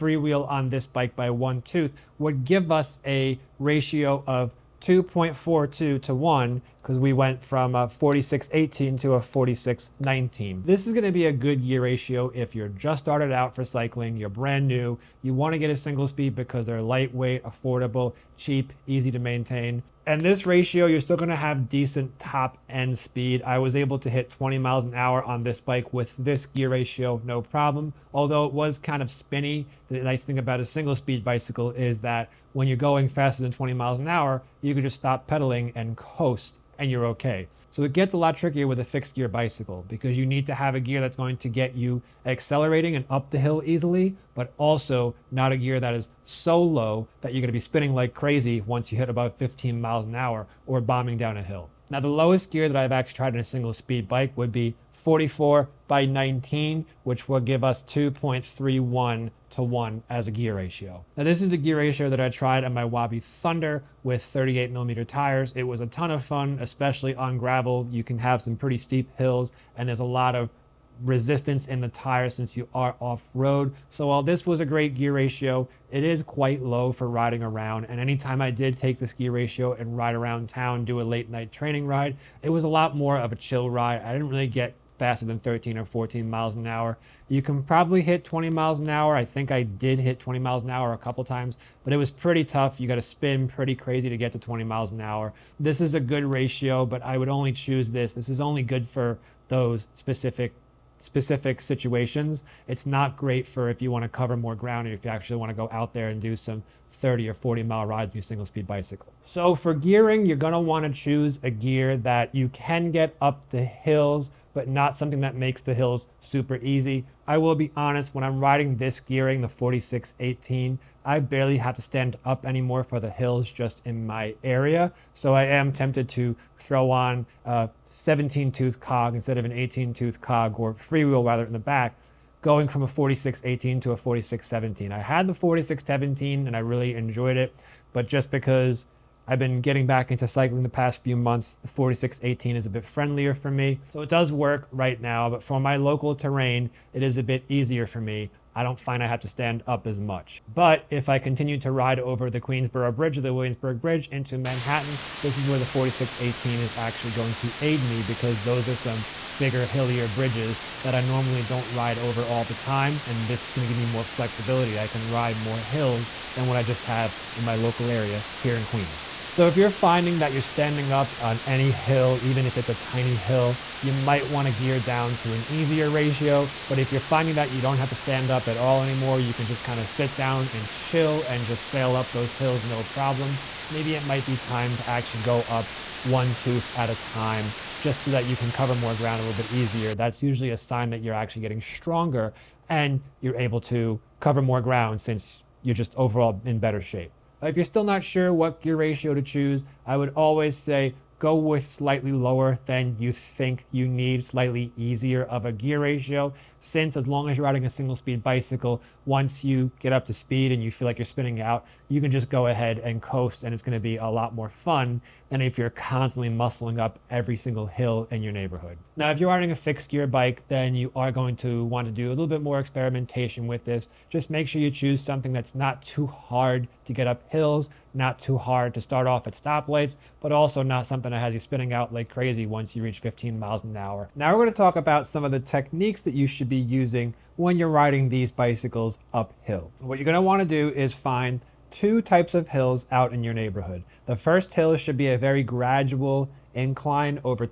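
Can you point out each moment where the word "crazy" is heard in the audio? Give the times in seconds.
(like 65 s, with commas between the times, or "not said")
48 s, 93 s, 232 s.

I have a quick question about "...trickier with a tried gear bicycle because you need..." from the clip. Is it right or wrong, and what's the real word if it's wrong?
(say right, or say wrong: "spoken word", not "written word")
wrong: "fixed", not "tried".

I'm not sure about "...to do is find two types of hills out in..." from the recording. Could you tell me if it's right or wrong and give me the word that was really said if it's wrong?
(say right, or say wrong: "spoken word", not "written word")
right.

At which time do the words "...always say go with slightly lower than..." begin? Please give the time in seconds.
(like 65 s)
200 s.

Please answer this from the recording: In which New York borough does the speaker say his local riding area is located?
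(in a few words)
Queens.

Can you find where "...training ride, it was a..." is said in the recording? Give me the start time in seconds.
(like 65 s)
81 s.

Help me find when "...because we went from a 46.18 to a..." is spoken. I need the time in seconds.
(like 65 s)
6 s.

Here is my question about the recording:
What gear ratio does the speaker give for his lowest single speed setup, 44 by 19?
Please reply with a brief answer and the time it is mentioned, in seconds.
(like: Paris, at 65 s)
2.31 to 1, at 57 s.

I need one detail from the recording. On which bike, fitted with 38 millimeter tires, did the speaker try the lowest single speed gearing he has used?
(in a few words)
Wabi Thunder.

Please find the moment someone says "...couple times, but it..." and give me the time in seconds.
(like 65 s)
90 s.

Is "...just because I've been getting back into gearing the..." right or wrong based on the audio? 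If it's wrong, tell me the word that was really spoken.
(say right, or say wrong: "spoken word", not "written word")
wrong: "cycling", not "gearing".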